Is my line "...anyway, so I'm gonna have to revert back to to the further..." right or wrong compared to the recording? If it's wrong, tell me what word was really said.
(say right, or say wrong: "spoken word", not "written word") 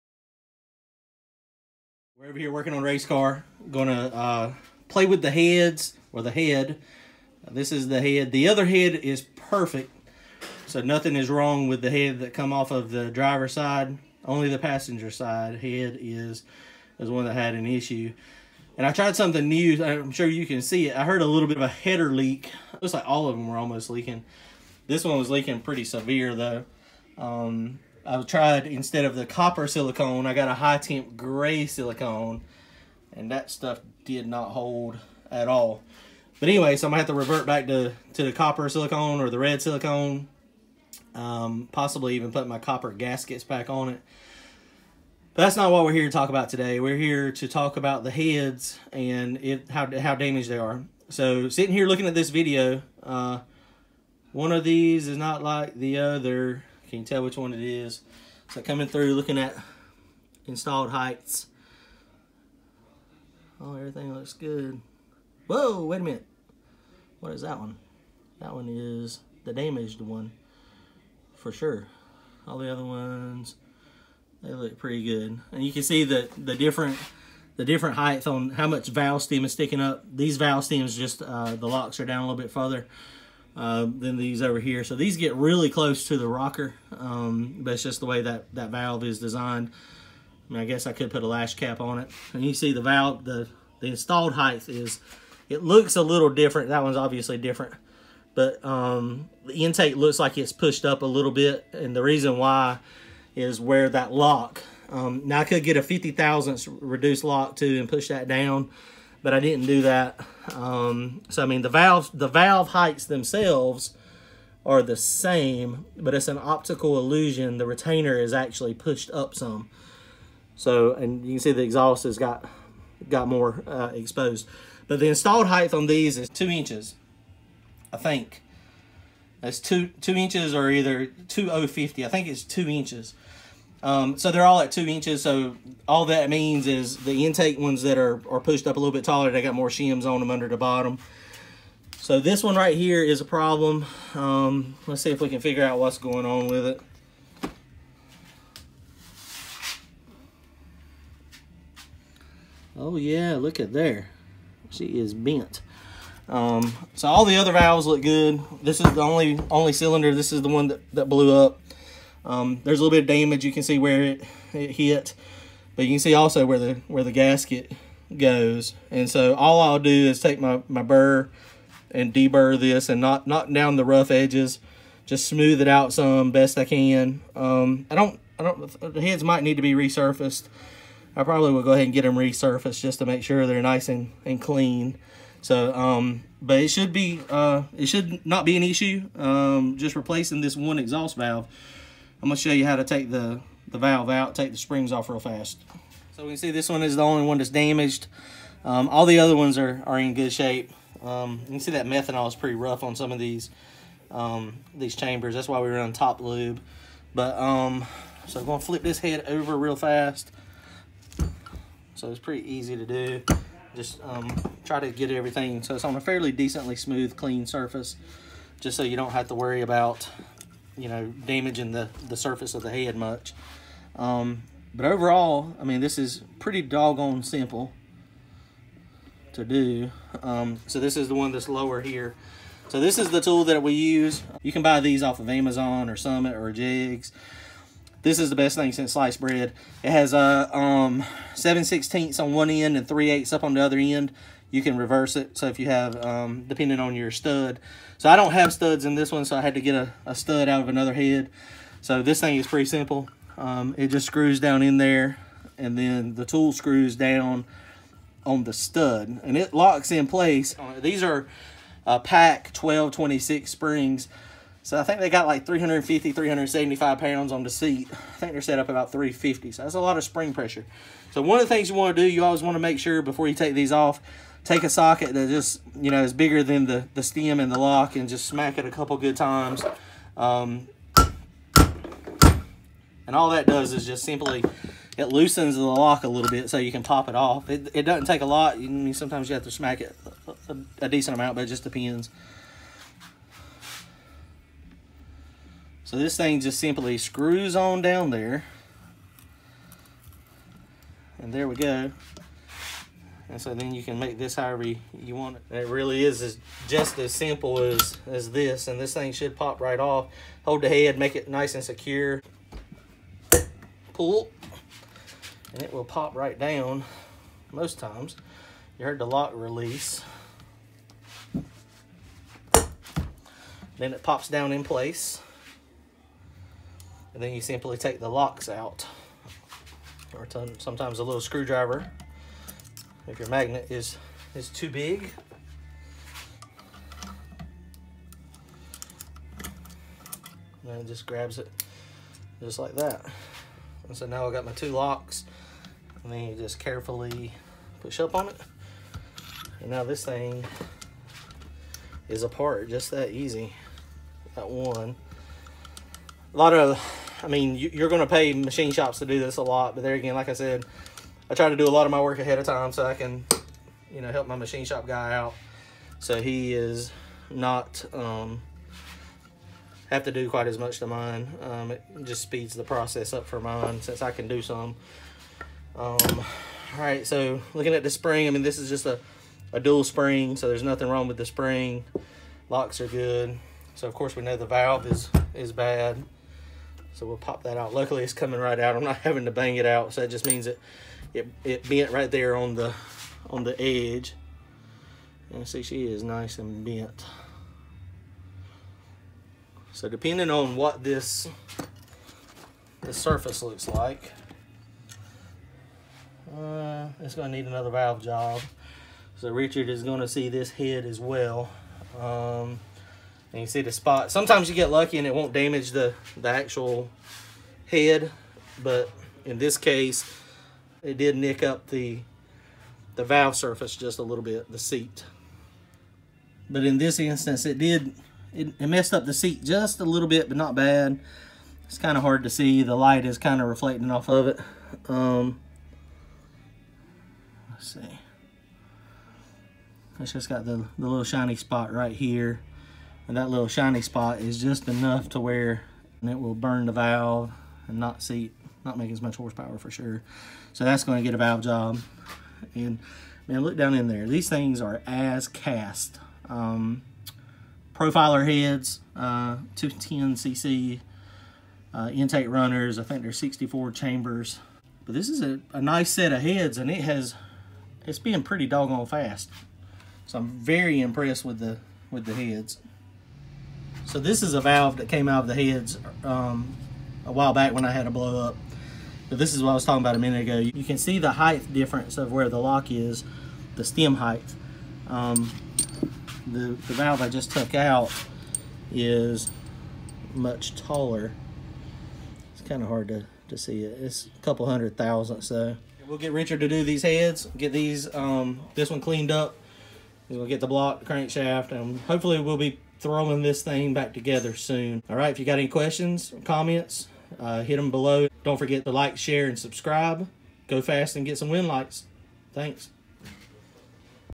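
wrong: "copper", not "further".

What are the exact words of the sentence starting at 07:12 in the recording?
The light is kind of reflecting off of it.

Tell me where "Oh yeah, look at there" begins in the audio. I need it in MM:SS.
02:32.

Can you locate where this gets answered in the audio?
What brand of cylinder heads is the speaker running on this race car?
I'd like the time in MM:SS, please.
07:37.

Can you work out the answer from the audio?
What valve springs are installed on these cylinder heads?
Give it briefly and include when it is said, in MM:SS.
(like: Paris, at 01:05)
PAC 1226, at 04:22.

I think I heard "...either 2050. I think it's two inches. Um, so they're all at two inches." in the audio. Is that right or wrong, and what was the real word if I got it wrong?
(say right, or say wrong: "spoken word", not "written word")
right.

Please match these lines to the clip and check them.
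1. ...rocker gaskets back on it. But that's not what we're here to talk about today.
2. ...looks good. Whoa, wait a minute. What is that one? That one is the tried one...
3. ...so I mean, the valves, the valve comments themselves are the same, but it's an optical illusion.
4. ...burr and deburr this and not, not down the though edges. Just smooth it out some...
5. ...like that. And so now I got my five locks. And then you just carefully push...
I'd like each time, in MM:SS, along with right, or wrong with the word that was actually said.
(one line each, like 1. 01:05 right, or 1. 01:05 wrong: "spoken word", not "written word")
1. 00:42 wrong: "copper", not "rocker"
2. 01:04 wrong: "damaged", not "tried"
3. 01:51 wrong: "heights", not "comments"
4. 02:50 wrong: "rough", not "though"
5. 05:42 wrong: "two", not "five".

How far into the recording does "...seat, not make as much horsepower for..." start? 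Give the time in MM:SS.
07:28.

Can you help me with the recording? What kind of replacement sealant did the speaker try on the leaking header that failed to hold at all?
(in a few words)
high temp gray silicone.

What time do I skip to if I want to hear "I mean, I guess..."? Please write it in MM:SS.
01:30.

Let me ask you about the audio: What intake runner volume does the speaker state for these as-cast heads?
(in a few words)
210cc.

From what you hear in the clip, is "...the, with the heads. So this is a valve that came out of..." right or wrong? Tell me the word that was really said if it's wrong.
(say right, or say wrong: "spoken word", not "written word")
right.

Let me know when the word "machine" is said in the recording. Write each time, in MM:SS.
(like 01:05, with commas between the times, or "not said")
05:58, 06:04.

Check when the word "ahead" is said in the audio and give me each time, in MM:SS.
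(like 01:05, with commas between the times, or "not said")
03:01, 06:02.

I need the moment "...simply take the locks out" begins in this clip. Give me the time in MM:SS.
05:27.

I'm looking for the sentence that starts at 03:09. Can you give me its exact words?
Um, just replacing this one exhaust valve.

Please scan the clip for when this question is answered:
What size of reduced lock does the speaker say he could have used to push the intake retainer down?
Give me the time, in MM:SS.
01:45.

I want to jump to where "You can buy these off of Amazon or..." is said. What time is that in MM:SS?
03:54.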